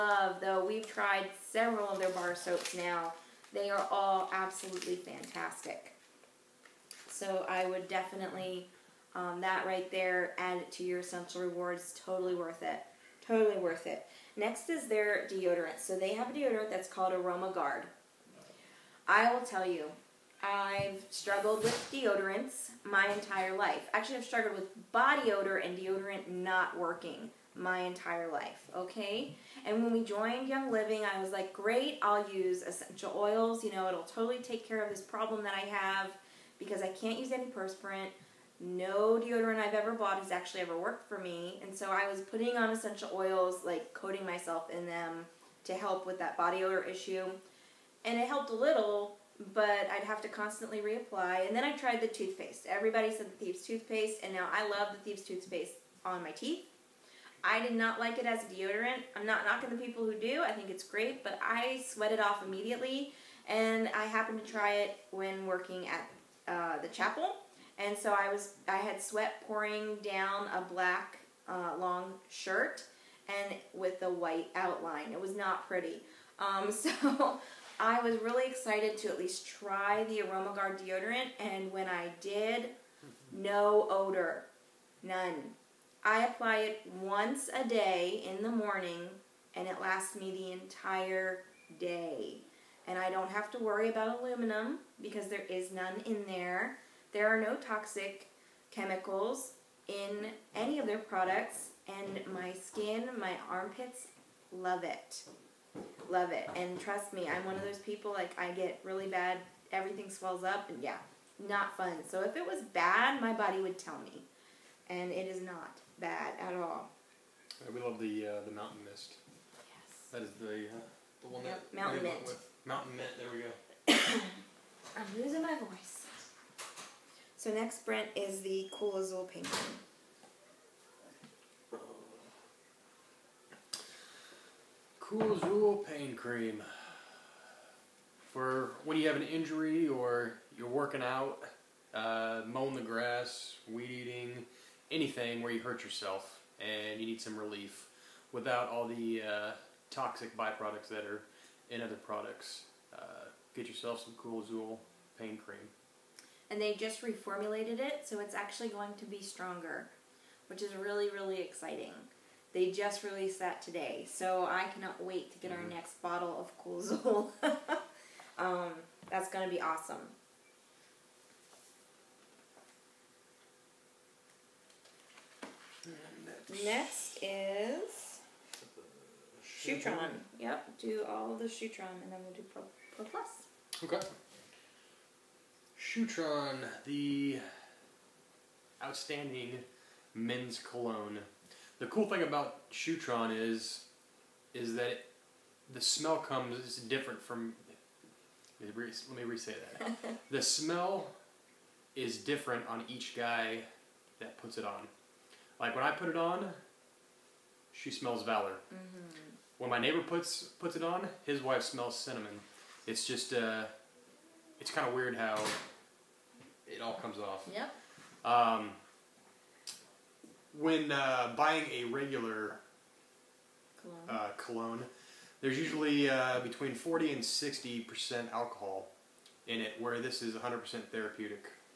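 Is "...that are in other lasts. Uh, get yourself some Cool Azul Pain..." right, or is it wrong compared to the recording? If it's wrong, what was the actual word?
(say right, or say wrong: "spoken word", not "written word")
wrong: "products", not "lasts".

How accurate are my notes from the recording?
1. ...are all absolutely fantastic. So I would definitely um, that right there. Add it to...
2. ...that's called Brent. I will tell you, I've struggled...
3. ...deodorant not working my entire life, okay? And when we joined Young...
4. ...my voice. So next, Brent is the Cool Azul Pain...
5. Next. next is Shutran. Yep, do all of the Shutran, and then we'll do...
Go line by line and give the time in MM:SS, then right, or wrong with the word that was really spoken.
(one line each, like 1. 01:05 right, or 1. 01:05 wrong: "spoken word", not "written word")
1. 00:03 right
2. 00:16 wrong: "AromaGuard", not "Brent"
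3. 00:25 right
4. 02:05 right
5. 02:56 right.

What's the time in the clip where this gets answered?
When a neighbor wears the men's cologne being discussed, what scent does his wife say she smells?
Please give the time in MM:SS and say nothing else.
03:31.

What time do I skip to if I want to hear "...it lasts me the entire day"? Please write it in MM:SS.
01:29.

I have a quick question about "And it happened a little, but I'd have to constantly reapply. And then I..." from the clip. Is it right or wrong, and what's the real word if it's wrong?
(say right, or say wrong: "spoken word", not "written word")
wrong: "helped", not "happened".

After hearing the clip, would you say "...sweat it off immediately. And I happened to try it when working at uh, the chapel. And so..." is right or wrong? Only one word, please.
right.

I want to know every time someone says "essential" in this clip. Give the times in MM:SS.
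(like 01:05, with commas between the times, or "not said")
00:11, 00:32, 00:42.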